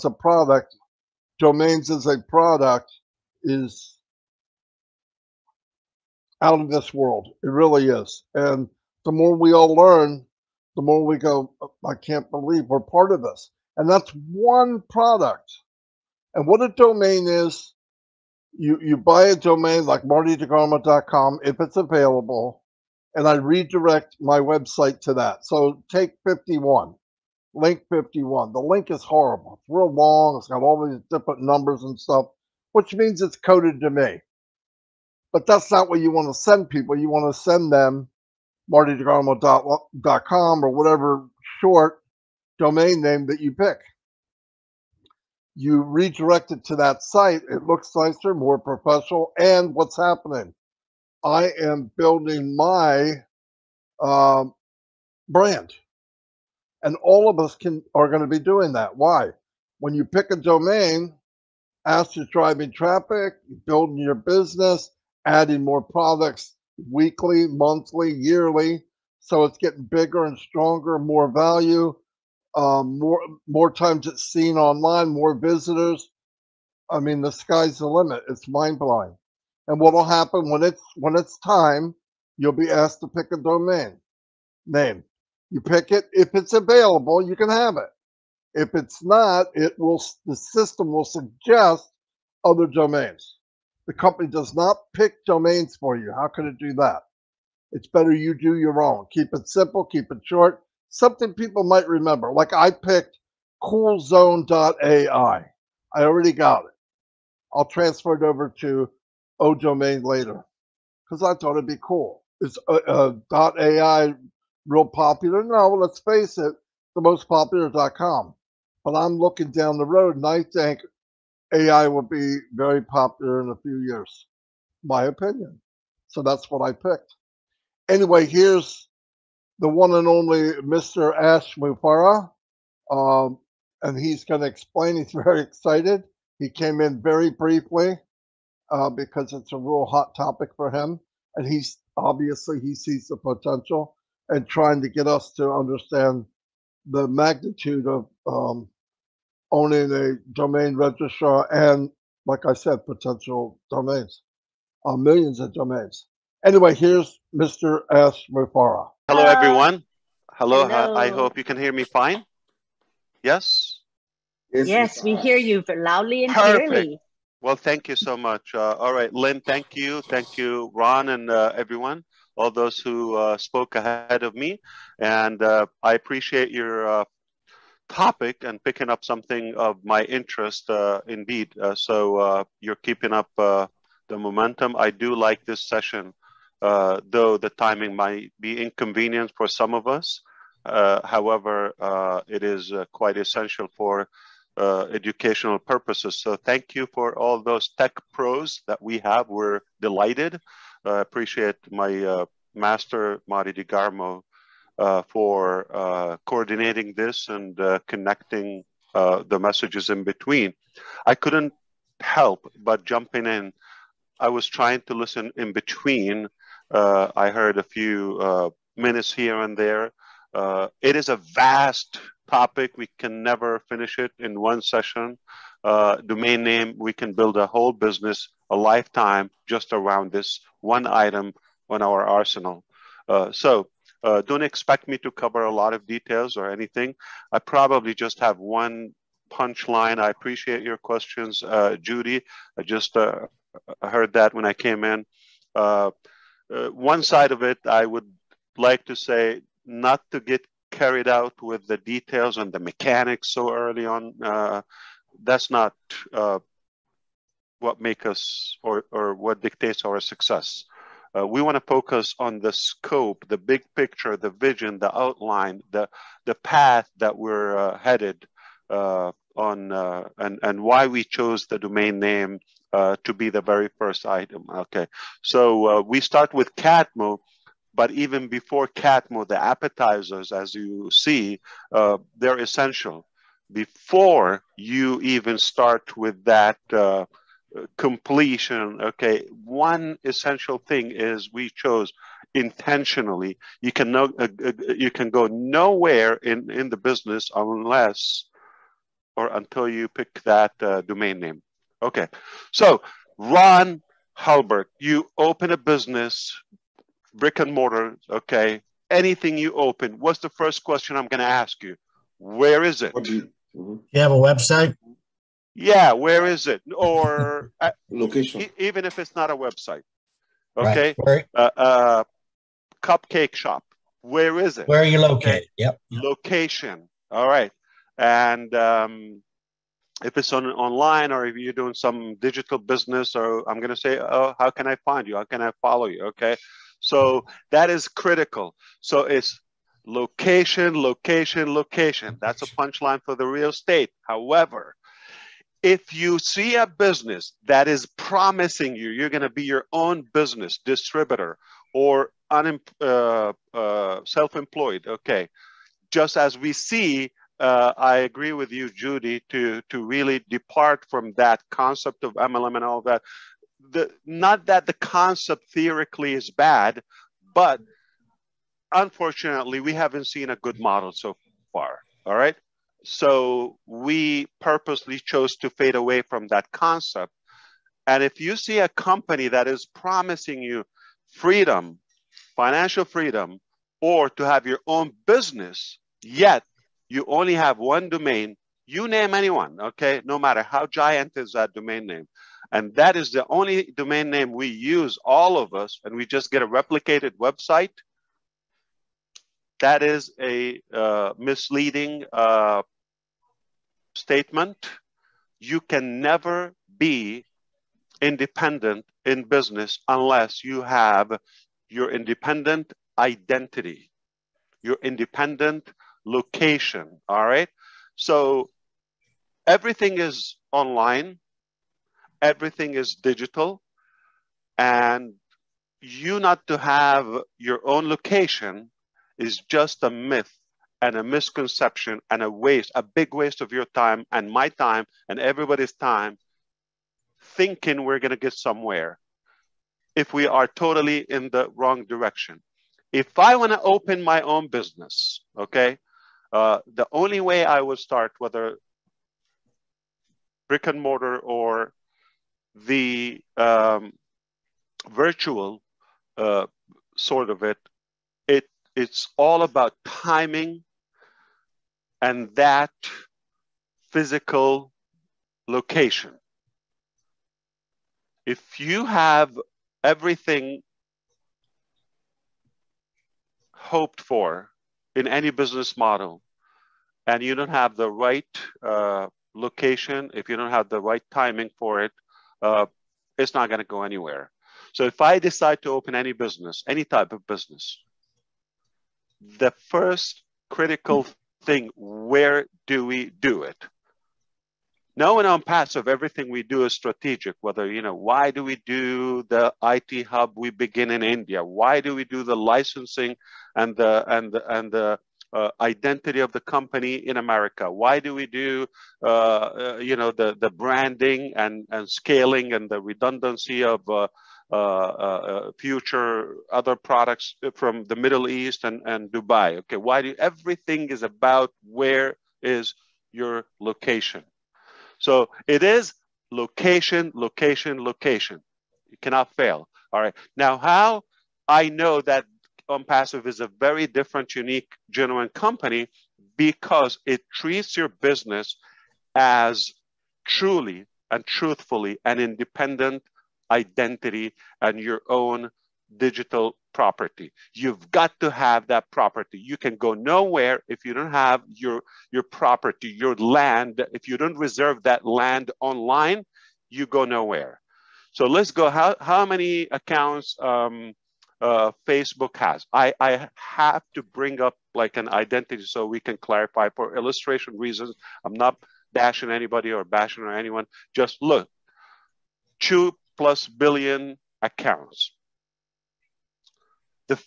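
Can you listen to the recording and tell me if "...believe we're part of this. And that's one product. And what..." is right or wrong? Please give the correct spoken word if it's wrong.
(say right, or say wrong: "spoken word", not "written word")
right.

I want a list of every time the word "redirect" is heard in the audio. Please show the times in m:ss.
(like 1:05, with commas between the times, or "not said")
0:23, 0:45.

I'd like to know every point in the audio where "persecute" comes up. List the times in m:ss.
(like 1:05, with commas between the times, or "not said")
not said.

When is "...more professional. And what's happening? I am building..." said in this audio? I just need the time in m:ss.
0:48.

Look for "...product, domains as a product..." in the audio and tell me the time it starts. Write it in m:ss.
0:00.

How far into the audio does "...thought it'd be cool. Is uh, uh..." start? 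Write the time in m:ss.
1:51.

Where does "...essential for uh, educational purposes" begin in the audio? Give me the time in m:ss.
3:13.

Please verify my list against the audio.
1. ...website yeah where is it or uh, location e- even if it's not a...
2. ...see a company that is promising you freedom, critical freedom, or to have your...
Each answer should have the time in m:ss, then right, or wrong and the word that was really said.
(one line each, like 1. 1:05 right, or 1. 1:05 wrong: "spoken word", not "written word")
1. 5:14 right
2. 6:18 wrong: "financial", not "critical".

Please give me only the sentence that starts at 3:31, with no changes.
I couldn't help but jumping in.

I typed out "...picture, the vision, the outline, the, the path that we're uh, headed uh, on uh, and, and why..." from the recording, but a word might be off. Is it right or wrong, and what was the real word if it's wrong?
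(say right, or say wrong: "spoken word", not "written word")
right.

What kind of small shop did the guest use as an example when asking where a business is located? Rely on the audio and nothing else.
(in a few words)
cupcake shop.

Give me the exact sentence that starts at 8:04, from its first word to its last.
So if I decide to open any business, any type of business, the first critical thing, where do we do it?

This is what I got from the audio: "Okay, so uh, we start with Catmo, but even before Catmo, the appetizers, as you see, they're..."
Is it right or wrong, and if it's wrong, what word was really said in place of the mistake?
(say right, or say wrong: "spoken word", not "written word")
right.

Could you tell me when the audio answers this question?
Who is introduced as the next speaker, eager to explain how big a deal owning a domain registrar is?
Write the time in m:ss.
2:11.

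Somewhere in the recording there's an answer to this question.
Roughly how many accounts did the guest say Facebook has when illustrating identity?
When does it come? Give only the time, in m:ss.
9:32.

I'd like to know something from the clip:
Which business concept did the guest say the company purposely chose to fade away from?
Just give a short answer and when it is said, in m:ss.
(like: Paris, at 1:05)
MLM, at 6:02.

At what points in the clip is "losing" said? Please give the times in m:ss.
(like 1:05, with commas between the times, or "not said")
not said.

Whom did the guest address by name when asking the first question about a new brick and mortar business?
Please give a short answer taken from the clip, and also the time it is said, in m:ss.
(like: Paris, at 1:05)
Ron Halbert, at 5:03.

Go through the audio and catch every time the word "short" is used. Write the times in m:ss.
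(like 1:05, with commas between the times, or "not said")
0:41, 1:40.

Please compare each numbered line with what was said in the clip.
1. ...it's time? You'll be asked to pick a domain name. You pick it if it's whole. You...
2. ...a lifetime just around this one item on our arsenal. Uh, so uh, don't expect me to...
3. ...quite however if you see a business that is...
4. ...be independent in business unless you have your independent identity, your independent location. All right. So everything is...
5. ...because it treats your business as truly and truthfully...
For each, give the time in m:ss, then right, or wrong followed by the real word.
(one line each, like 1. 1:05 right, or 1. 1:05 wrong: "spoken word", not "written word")
1. 1:21 wrong: "available", not "whole"
2. 3:48 right
3. 5:43 wrong: "estate", not "quite"
4. 6:46 right
5. 8:56 right.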